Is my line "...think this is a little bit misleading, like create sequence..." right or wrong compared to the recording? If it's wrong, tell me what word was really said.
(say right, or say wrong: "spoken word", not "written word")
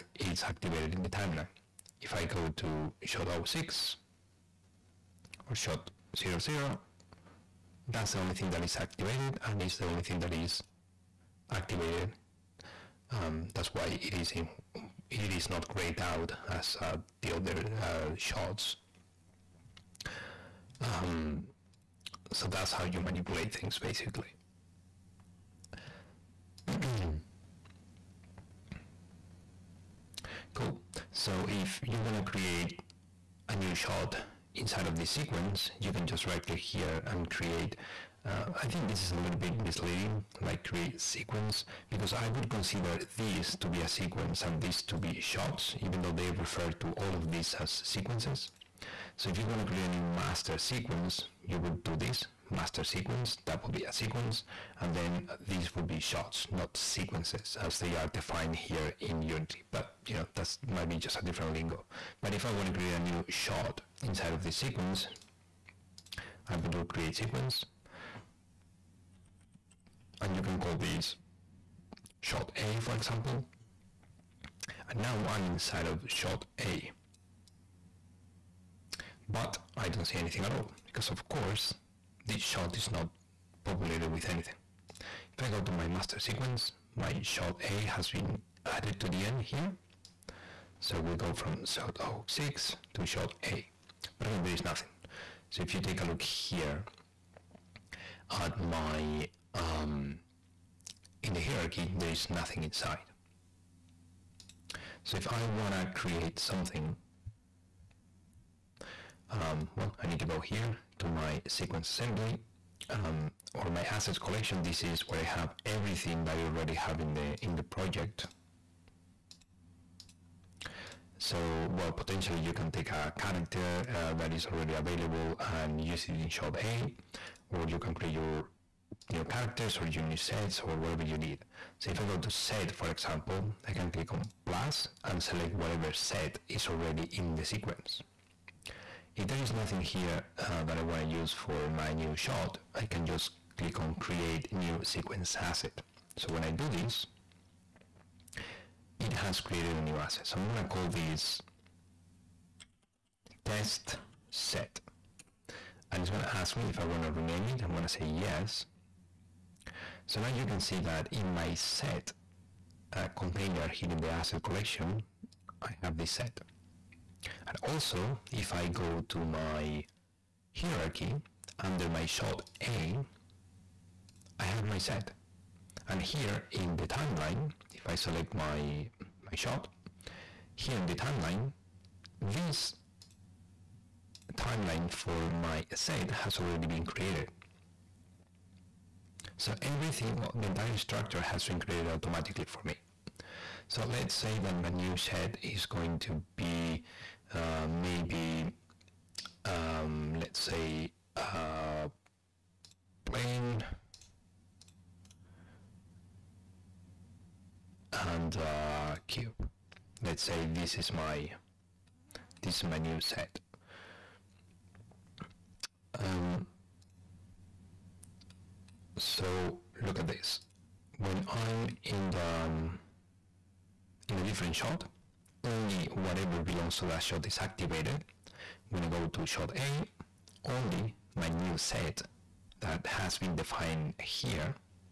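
right.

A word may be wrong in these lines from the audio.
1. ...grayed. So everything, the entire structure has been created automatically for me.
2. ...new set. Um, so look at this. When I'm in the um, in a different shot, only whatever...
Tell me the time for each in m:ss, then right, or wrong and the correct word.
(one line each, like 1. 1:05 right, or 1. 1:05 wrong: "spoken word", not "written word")
1. 3:06 wrong: "created", not "grayed"
2. 3:32 right.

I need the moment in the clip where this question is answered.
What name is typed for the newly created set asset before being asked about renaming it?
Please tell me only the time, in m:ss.
2:33.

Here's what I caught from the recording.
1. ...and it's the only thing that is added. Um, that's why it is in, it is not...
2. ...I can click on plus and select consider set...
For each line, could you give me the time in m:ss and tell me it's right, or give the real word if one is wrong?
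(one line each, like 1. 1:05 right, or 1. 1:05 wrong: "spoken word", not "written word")
1. 0:09 wrong: "activated", not "added"
2. 2:13 wrong: "whatever", not "consider".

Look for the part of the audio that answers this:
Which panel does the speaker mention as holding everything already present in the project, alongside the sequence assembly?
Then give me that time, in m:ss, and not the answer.
1:53.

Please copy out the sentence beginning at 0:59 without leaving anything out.
But you know, that might be just a different lingo.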